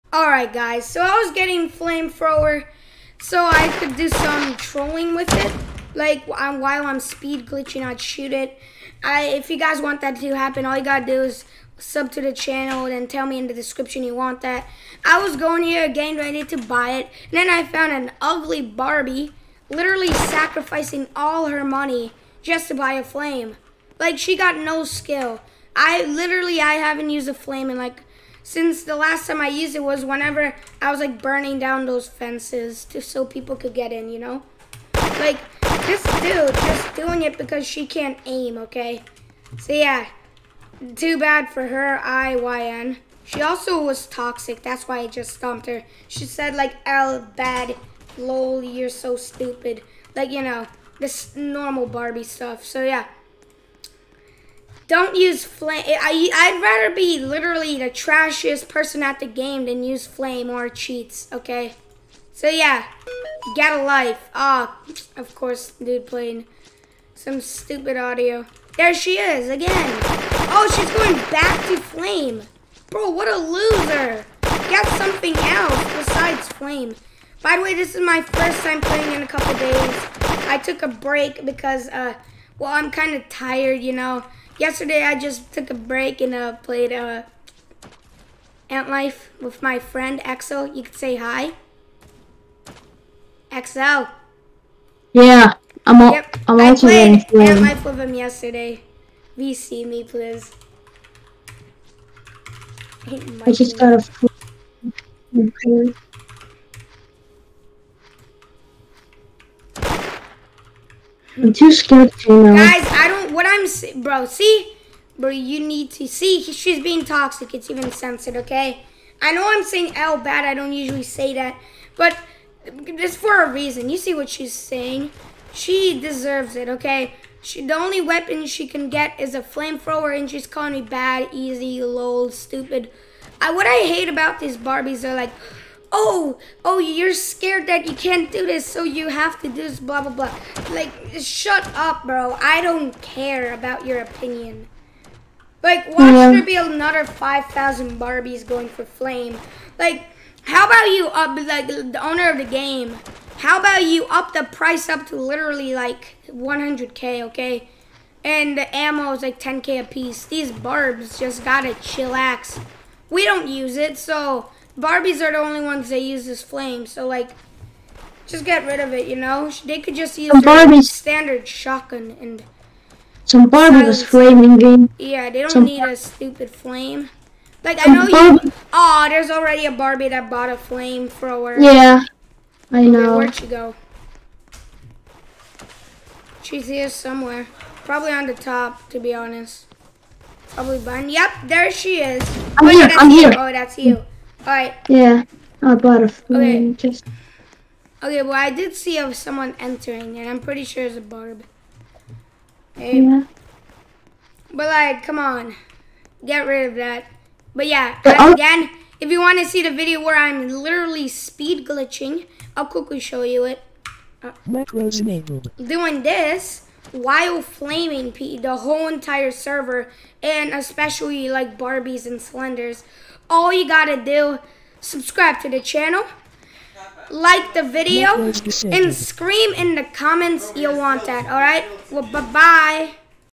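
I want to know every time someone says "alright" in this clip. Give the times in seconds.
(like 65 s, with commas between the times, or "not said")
0 s, 194 s, 231 s.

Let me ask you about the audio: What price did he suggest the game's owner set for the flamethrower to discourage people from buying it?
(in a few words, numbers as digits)
100k.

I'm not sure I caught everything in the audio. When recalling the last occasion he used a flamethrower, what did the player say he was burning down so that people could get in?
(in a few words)
fences.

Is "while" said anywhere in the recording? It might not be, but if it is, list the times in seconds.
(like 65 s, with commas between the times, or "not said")
6 s, 216 s.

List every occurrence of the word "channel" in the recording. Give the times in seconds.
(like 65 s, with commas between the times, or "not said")
12 s, 225 s.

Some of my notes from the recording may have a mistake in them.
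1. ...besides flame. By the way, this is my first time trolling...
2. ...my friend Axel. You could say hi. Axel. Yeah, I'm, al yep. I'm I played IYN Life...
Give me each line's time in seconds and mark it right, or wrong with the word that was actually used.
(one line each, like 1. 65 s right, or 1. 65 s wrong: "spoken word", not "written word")
1. 76 s wrong: "playing", not "trolling"
2. 89 s wrong: "Ant", not "IYN".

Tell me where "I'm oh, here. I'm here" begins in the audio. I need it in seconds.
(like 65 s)
192 s.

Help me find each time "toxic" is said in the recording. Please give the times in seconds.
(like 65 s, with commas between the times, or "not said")
44 s, 117 s.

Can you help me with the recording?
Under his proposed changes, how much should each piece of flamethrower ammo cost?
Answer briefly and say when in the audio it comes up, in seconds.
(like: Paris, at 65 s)
10k, at 159 s.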